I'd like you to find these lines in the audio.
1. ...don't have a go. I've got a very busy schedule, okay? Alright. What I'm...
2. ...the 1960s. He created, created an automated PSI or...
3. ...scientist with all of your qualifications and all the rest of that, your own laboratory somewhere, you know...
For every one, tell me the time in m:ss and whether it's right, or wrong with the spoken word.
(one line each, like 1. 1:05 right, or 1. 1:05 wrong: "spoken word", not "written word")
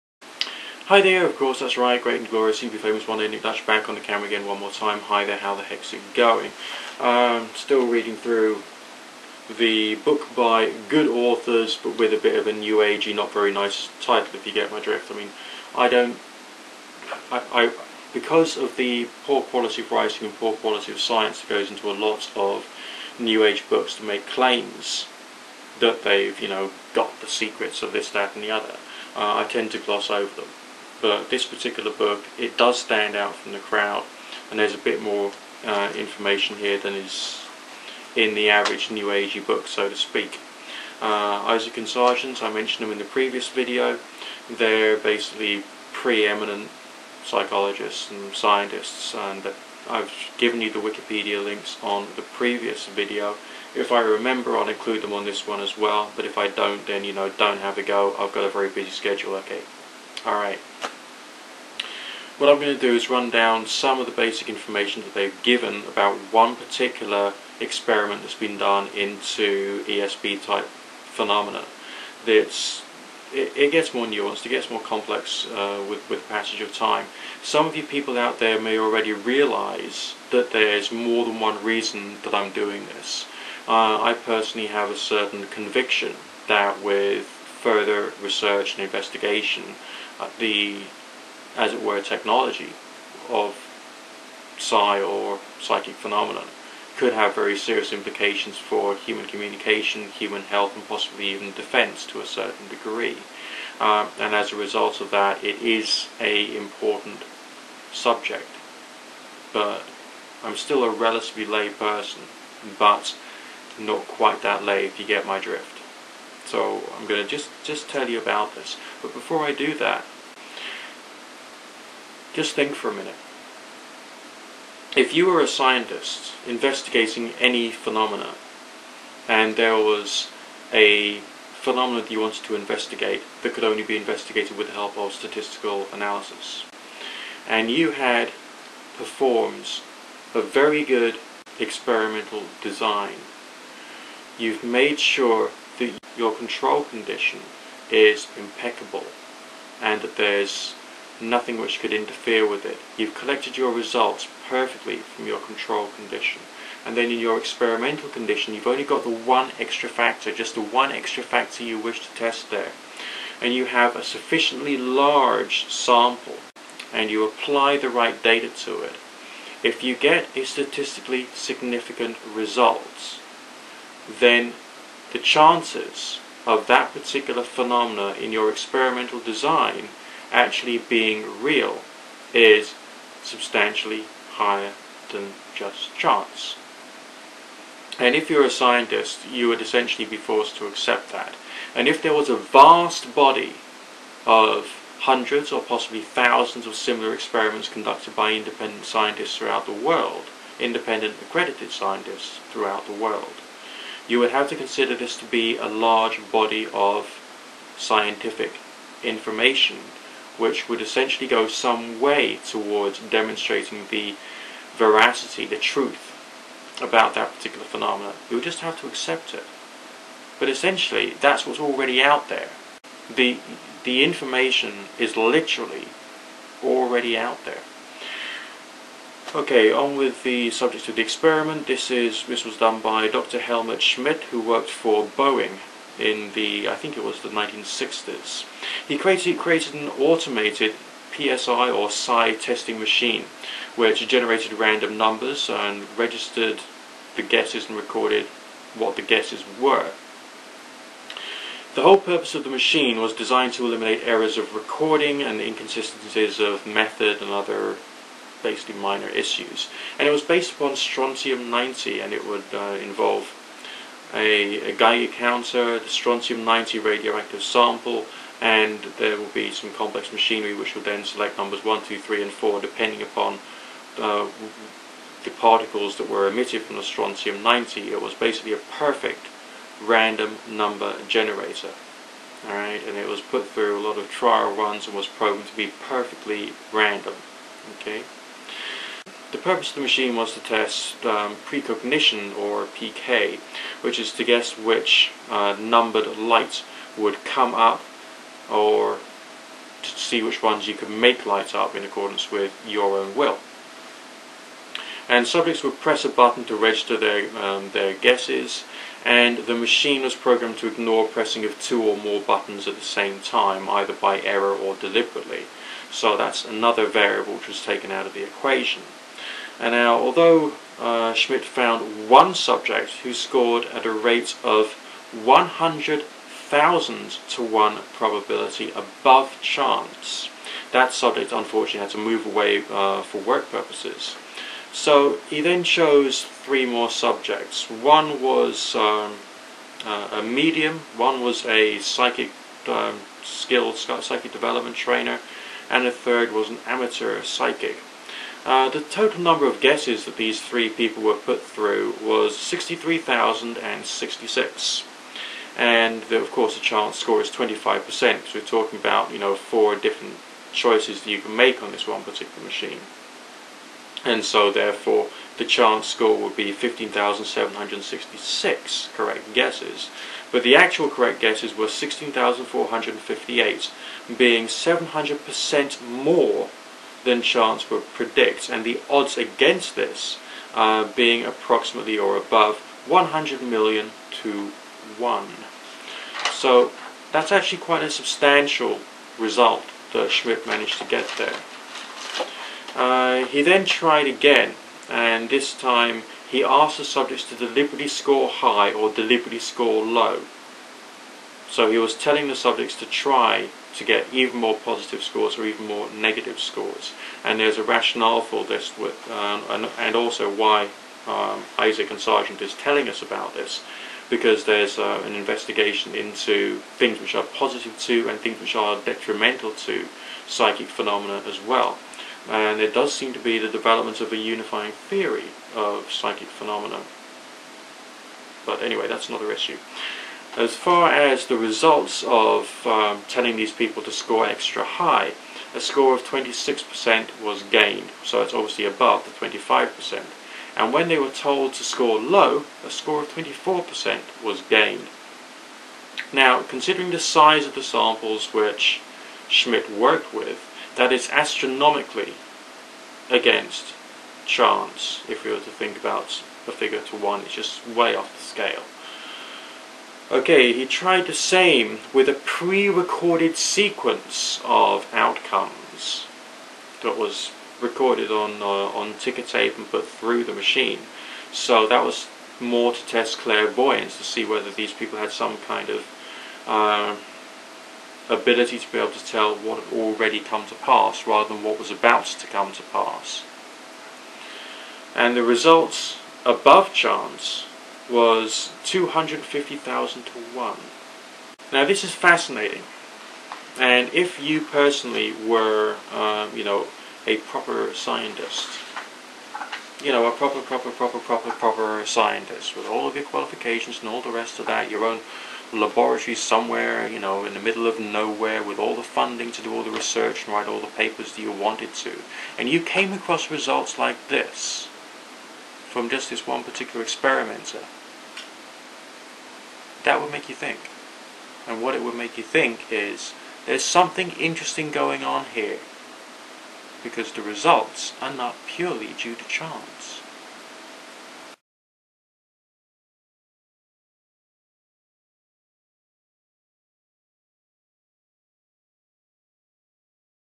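1. 0:57 right
2. 3:57 right
3. 8:21 right.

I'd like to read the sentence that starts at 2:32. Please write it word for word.
You've collected your results perfectly from your control condition.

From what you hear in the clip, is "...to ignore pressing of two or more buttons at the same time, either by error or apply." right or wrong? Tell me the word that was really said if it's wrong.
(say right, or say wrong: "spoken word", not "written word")
wrong: "deliberately", not "apply".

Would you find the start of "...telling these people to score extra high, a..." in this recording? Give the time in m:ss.
7:13.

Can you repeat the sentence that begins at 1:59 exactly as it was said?
But before I do that, just think for a minute.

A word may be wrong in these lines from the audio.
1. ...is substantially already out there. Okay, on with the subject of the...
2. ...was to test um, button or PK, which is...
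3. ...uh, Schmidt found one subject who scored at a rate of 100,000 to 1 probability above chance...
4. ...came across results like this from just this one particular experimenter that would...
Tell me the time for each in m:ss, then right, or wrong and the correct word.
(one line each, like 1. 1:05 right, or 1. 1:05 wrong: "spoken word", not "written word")
1. 3:44 wrong: "literally", not "substantially"
2. 4:50 wrong: "precognition", not "button"
3. 5:20 right
4. 8:32 right.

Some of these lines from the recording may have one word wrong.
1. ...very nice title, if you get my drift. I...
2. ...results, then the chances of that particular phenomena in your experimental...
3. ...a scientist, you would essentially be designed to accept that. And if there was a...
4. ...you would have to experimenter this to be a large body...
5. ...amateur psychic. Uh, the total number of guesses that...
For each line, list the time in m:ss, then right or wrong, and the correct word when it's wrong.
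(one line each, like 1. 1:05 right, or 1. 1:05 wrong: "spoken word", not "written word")
1. 0:13 right
2. 2:52 right
3. 3:08 wrong: "forced", not "designed"
4. 3:24 wrong: "consider", not "experimenter"
5. 5:46 right.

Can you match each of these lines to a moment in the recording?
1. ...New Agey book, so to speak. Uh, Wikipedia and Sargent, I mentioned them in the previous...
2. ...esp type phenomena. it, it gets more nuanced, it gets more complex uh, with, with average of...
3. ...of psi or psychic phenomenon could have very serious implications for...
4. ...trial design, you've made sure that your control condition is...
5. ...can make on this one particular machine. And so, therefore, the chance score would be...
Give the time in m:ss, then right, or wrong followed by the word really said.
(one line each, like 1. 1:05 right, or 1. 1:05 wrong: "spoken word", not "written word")
1. 0:38 wrong: "Eysenck", not "Wikipedia"
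2. 1:09 wrong: "passage", not "average"
3. 1:33 right
4. 2:21 wrong: "experimental", not "trial"
5. 6:01 right.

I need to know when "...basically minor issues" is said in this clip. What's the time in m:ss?
4:18.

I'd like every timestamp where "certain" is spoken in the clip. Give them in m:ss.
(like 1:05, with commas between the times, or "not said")
1:24, 1:42.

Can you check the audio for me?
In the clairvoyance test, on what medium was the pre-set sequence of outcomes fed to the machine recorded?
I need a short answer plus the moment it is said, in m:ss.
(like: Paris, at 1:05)
ticker tape, at 7:48.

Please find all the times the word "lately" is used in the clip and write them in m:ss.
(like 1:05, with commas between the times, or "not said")
not said.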